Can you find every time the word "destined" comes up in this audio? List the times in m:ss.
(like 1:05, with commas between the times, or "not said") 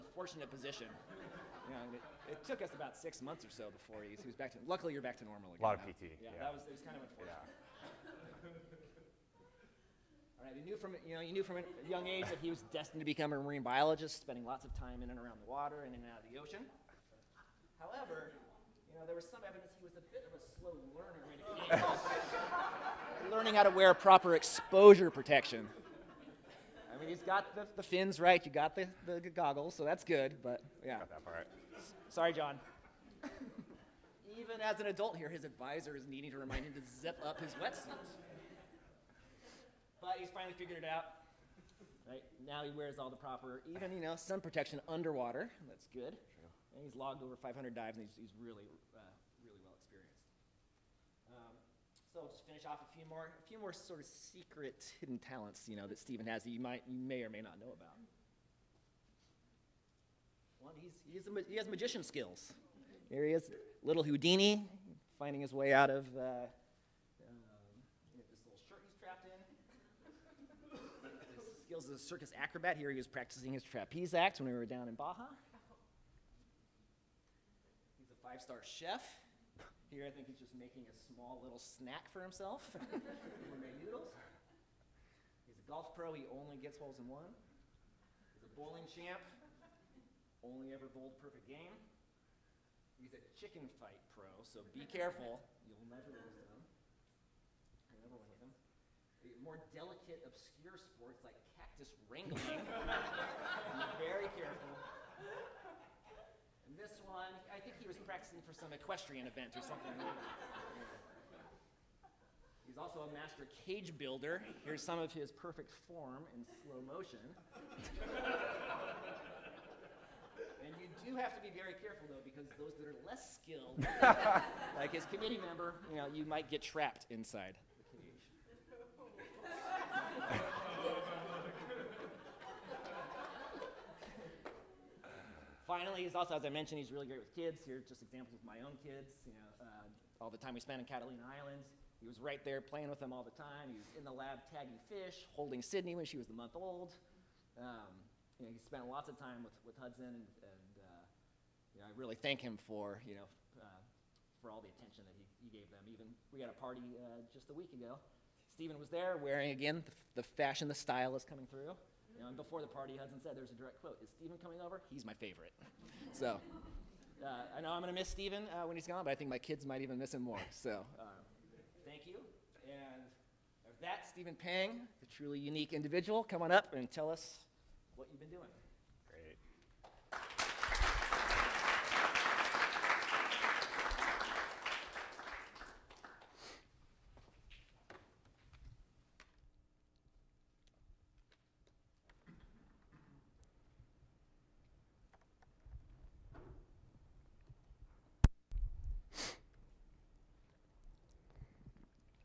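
0:12.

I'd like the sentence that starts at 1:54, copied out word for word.
Here's some of his perfect form in slow motion.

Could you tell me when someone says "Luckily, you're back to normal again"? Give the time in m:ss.
0:04.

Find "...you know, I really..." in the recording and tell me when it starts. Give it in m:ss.
2:31.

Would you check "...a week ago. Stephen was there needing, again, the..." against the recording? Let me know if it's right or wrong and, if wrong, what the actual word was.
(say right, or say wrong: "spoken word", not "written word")
wrong: "wearing", not "needing".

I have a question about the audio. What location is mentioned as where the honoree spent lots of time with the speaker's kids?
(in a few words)
Catalina Islands.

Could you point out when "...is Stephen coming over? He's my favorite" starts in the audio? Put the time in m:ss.
2:44.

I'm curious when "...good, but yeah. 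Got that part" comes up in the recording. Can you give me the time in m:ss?
0:30.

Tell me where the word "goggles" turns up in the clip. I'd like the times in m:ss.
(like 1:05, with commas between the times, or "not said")
0:29.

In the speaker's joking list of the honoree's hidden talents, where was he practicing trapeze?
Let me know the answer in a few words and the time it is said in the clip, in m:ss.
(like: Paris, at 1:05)
Baja, at 1:14.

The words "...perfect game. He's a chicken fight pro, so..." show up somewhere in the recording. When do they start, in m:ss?
1:31.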